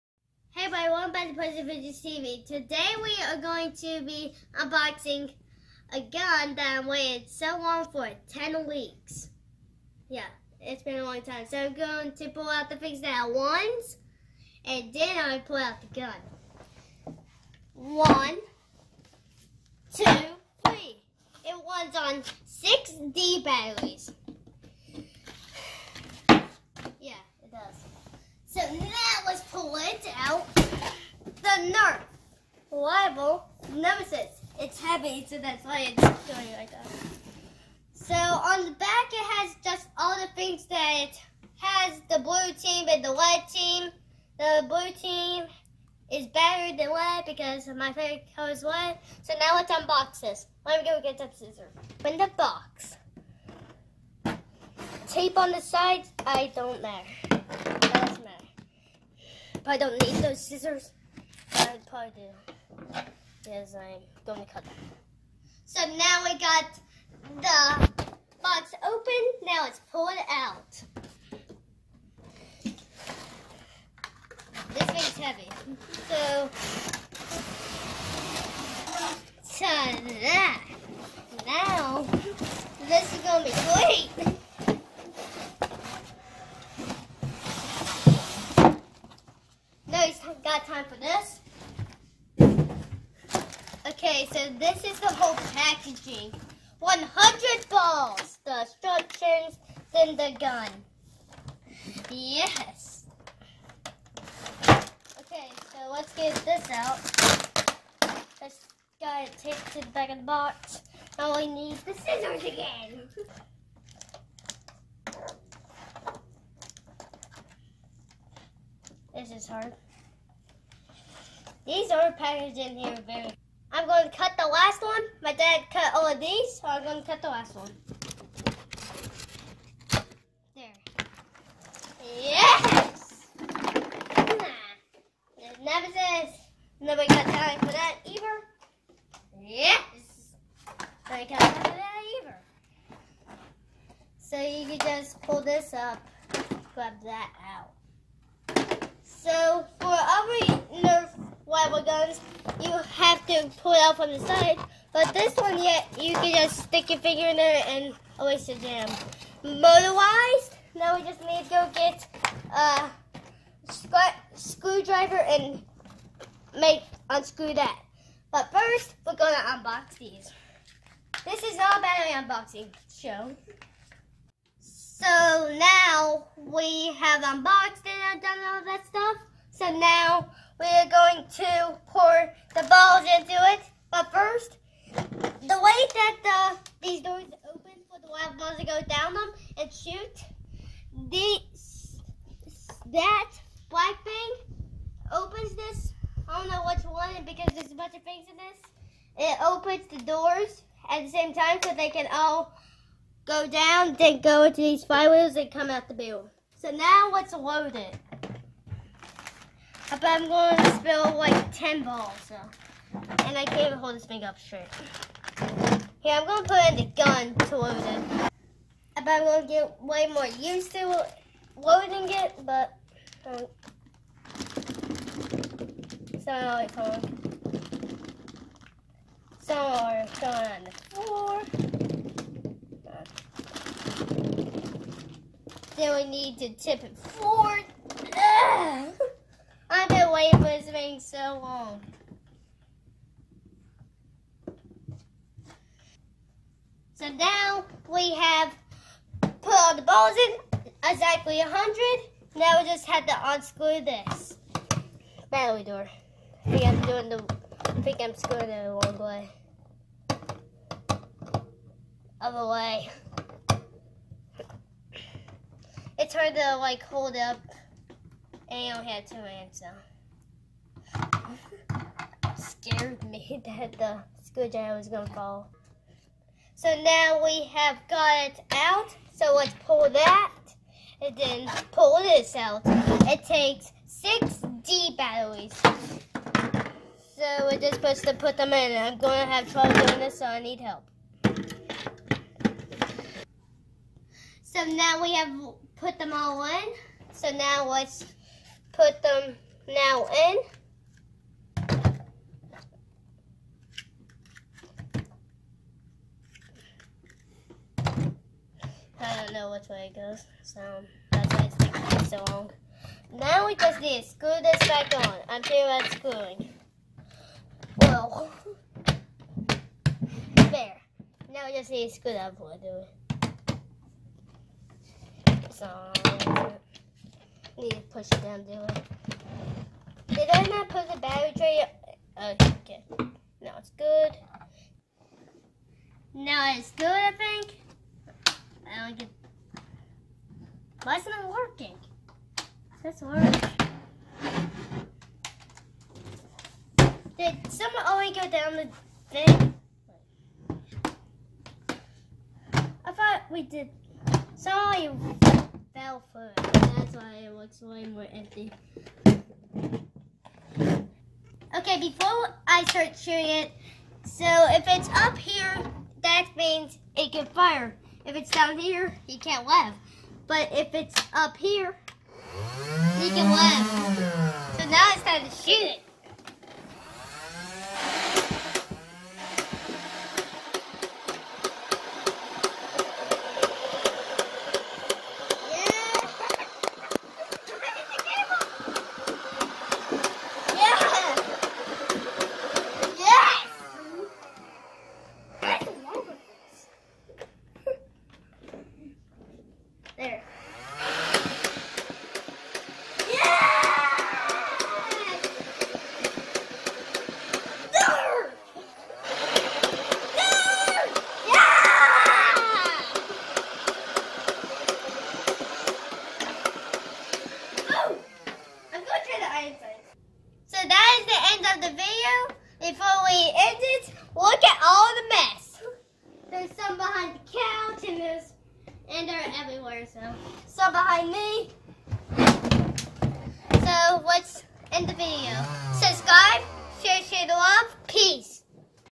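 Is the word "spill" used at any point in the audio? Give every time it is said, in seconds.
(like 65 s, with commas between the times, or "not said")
210 s.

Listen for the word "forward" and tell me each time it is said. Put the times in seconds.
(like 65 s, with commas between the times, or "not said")
236 s.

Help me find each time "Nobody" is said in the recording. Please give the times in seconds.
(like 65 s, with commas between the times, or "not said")
136 s, 141 s.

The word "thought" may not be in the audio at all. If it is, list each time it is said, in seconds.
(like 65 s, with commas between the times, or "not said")
352 s.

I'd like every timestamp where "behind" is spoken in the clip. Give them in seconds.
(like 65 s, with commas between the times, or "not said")
430 s.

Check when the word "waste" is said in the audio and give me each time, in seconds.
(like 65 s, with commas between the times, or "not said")
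158 s.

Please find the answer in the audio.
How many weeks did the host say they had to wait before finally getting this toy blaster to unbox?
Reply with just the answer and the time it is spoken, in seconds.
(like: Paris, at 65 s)
10, at 8 s.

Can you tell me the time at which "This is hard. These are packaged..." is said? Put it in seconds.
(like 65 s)
119 s.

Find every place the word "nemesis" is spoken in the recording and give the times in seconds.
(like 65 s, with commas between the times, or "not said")
33 s, 135 s.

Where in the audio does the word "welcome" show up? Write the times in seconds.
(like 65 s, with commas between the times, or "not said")
1 s.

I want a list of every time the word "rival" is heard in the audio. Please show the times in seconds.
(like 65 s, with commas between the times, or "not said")
32 s, 151 s.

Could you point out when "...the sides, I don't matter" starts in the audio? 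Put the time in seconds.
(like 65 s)
55 s.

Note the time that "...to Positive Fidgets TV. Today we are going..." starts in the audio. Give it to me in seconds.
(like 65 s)
1 s.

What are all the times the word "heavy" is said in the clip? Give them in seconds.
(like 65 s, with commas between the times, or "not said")
34 s, 75 s.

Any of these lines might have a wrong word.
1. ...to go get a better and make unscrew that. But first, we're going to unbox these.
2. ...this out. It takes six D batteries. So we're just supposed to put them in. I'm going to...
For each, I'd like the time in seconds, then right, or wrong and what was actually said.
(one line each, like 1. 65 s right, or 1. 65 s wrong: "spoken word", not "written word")
1. 161 s wrong: "screwdriver", not "better"
2. 282 s right.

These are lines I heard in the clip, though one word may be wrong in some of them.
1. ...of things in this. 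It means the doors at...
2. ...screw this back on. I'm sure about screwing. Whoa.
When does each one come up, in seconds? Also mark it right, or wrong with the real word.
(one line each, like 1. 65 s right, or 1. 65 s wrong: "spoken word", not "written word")
1. 197 s wrong: "opens", not "means"
2. 314 s right.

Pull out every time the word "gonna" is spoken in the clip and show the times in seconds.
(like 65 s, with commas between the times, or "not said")
274 s.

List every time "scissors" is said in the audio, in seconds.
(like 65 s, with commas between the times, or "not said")
51 s, 60 s, 111 s.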